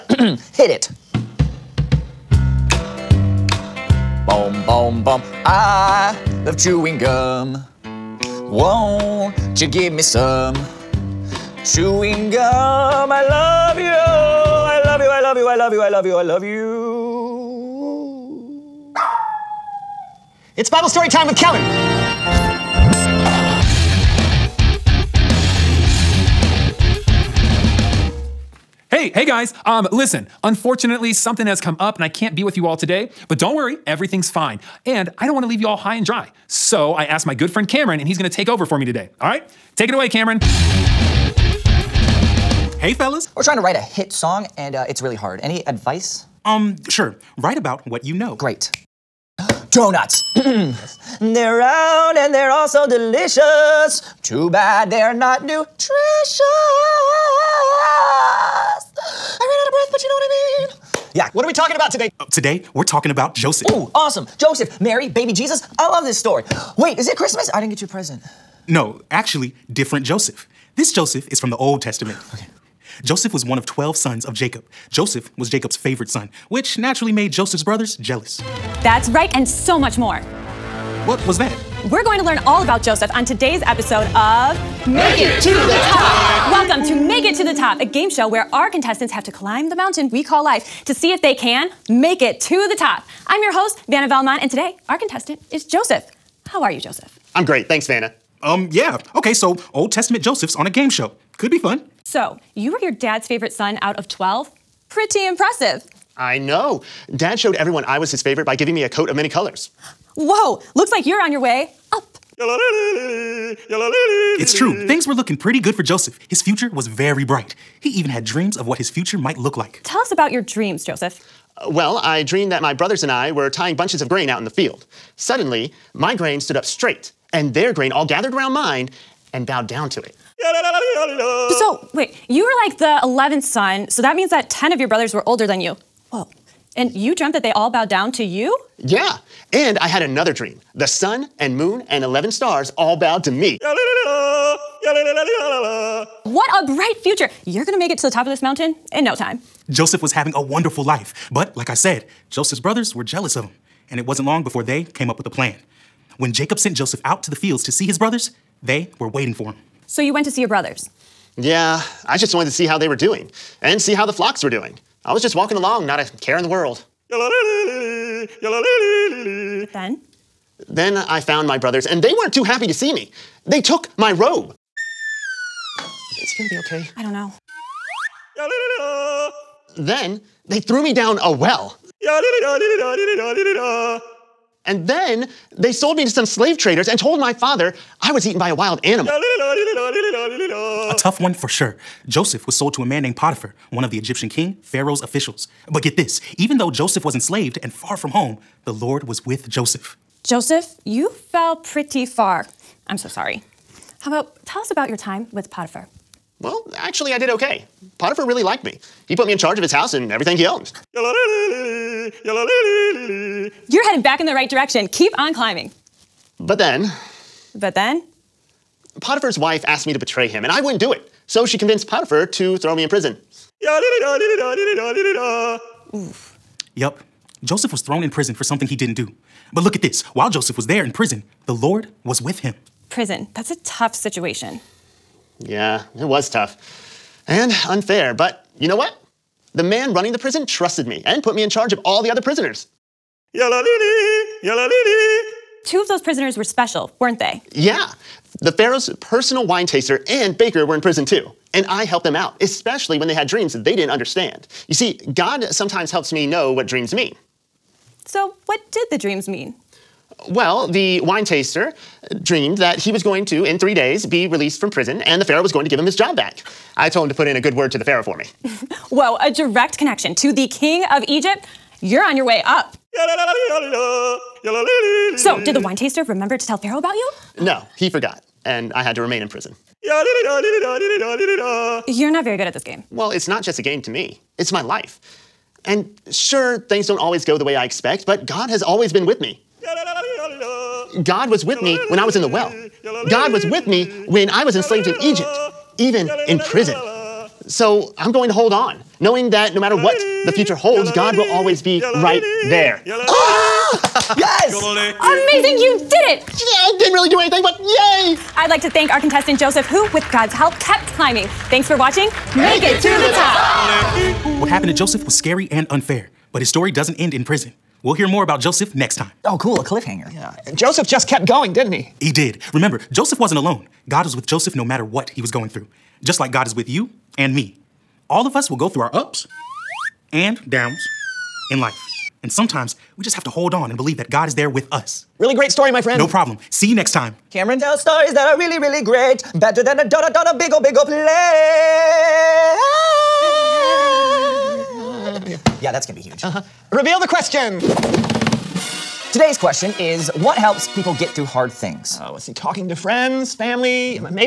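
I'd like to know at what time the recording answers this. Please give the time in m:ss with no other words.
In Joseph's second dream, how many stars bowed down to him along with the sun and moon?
2:22.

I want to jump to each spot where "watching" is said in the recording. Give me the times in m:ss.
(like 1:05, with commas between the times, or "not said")
5:11.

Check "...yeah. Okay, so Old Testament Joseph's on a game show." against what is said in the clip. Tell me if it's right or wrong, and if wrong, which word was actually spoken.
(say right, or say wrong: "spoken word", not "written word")
right.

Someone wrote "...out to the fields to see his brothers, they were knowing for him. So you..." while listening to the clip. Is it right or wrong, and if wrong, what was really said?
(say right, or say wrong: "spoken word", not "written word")
wrong: "waiting", not "knowing".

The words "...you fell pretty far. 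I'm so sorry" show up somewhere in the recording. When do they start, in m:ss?
3:20.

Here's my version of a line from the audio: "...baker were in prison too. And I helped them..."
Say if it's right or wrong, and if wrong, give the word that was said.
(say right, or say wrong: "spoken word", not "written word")
right.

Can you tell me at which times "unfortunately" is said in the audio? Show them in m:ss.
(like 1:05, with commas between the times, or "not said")
0:30.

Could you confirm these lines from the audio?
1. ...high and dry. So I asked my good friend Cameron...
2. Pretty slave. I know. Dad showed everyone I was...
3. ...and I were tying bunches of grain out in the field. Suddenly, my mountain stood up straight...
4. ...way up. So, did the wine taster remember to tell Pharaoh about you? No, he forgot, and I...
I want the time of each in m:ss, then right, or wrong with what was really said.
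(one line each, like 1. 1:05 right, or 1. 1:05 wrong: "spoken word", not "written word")
1. 0:35 right
2. 1:44 wrong: "impressive", not "slave"
3. 2:03 wrong: "grain", not "mountain"
4. 4:32 right.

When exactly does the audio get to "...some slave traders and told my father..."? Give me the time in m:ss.
3:06.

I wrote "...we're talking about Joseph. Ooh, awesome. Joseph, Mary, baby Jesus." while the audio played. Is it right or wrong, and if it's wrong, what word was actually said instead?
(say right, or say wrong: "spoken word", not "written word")
right.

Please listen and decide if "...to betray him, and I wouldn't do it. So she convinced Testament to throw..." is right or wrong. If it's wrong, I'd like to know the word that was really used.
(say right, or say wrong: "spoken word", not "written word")
wrong: "Potiphar", not "Testament".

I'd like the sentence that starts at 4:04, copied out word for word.
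Two of those prisoners were special, weren't they?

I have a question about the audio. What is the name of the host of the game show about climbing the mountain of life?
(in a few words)
Vanna Valmont.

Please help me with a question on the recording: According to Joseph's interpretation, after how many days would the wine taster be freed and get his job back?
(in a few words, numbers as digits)
3.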